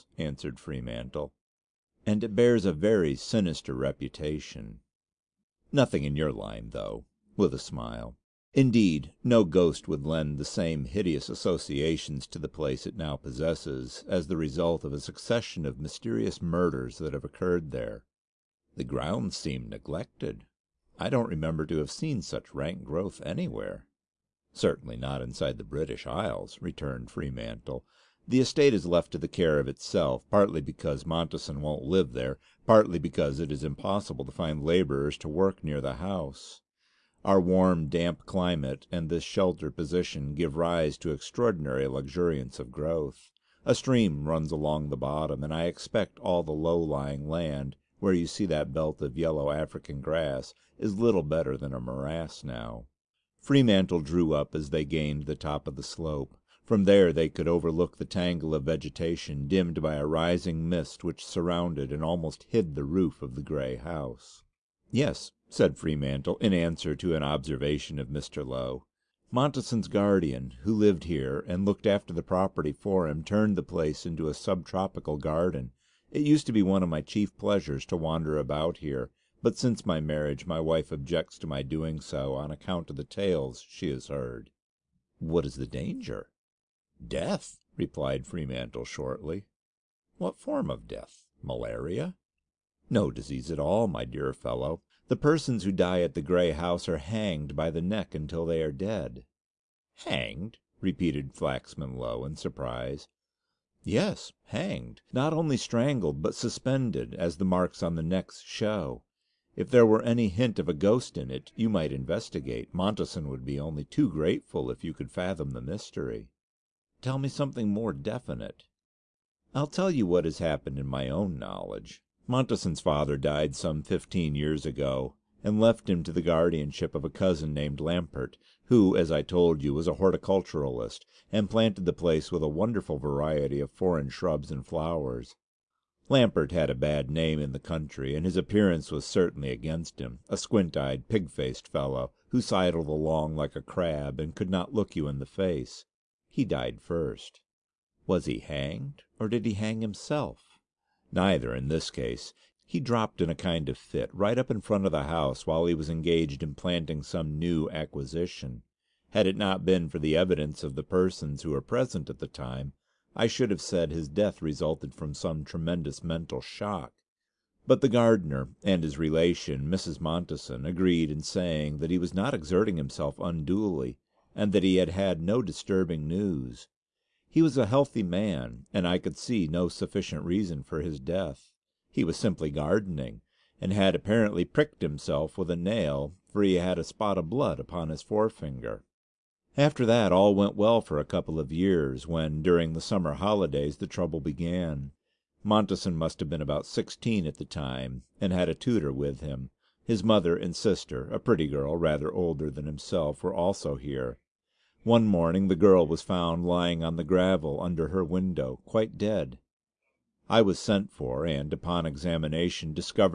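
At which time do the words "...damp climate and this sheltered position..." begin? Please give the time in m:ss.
0:37.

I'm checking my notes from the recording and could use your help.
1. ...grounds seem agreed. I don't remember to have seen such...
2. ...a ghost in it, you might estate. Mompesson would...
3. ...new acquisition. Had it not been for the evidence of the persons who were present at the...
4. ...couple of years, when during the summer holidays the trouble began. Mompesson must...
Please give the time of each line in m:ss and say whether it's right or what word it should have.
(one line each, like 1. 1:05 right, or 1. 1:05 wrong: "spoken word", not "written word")
1. 0:18 wrong: "neglected", not "agreed"
2. 1:50 wrong: "investigate", not "estate"
3. 2:37 right
4. 3:11 right.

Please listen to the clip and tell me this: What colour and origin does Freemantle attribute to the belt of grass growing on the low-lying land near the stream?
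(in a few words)
yellow African.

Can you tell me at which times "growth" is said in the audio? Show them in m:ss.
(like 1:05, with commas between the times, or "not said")
0:22, 0:42.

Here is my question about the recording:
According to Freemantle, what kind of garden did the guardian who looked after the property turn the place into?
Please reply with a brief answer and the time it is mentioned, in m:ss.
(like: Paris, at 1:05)
sub tropical, at 1:14.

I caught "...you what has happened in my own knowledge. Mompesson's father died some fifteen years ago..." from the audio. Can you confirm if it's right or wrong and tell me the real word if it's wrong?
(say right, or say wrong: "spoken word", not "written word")
right.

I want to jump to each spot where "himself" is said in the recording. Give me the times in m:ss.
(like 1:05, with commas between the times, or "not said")
2:29, 2:52, 3:04, 3:22.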